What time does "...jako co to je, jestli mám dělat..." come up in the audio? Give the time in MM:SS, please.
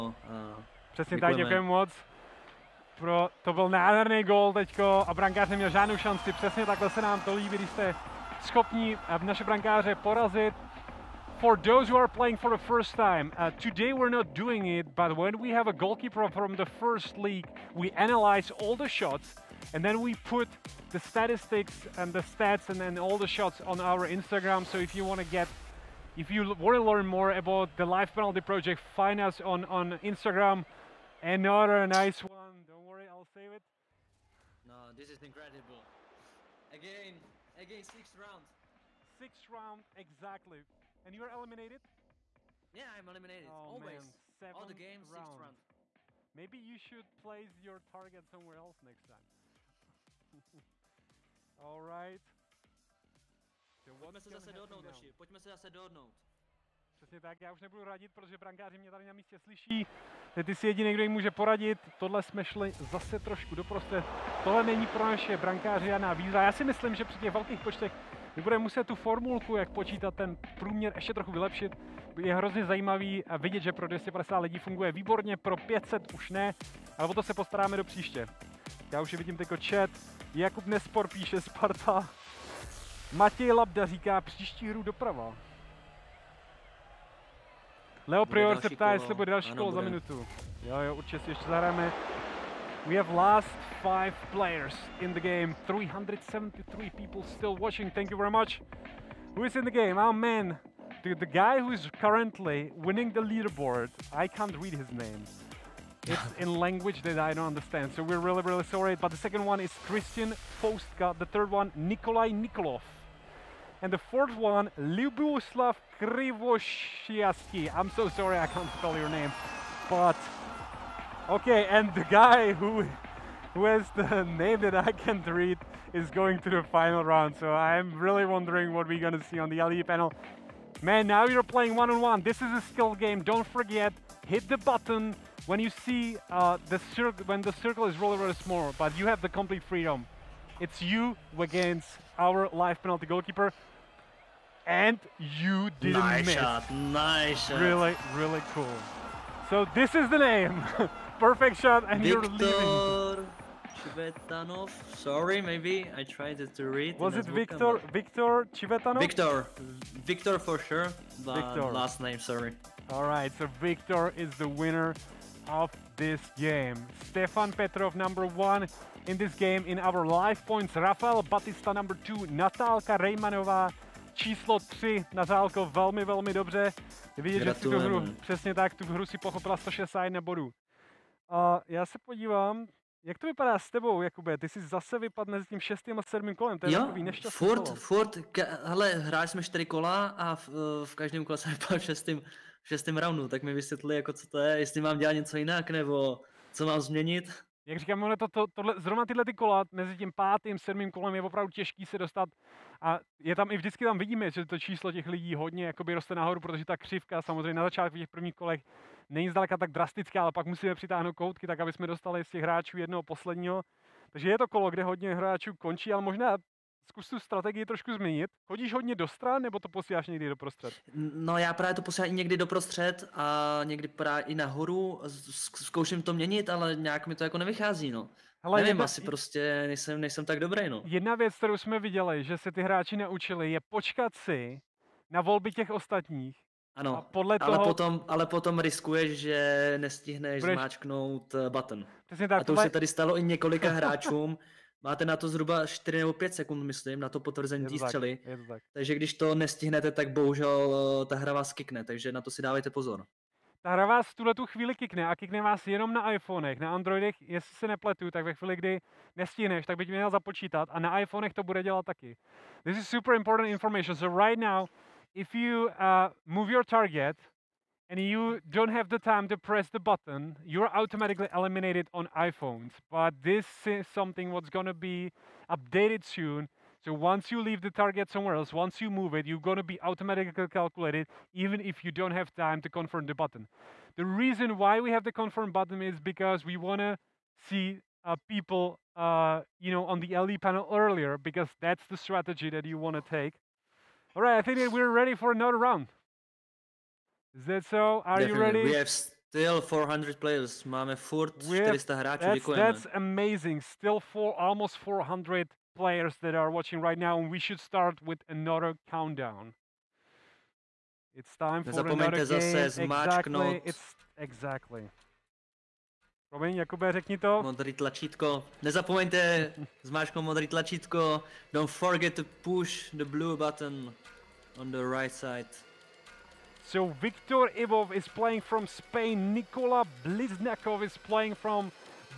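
03:13.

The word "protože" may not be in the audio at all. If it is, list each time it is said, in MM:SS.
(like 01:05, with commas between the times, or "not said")
00:58, 03:26.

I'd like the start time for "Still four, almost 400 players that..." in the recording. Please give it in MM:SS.
05:03.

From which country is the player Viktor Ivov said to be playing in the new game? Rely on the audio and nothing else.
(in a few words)
Spain.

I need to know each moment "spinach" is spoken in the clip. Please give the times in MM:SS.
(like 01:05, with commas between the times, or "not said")
not said.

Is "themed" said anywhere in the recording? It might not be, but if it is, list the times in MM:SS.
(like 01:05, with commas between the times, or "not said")
not said.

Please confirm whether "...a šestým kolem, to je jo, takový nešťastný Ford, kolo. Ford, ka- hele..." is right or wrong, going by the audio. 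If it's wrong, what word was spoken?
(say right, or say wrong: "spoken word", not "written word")
wrong: "sedmým", not "šestým".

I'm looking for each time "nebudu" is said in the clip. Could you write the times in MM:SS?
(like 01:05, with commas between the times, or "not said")
00:57.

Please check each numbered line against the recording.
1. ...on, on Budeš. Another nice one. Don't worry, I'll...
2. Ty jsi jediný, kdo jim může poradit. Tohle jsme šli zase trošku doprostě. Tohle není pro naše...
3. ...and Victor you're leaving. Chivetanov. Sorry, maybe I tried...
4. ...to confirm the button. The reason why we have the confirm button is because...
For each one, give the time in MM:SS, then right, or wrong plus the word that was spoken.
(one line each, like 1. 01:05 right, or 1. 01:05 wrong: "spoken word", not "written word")
1. 00:29 wrong: "Instagram", not "Budeš"
2. 01:00 right
3. 02:31 right
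4. 04:42 right.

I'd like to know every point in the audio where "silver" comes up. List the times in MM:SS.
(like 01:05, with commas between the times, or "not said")
not said.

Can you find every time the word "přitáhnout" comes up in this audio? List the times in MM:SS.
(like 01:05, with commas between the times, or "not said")
03:30.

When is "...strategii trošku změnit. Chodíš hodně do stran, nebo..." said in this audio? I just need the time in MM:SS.
03:37.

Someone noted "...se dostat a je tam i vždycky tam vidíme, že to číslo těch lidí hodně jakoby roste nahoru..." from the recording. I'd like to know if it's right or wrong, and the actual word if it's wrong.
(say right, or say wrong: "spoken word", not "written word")
right.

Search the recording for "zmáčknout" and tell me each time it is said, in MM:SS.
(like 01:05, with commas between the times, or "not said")
04:00, 05:19.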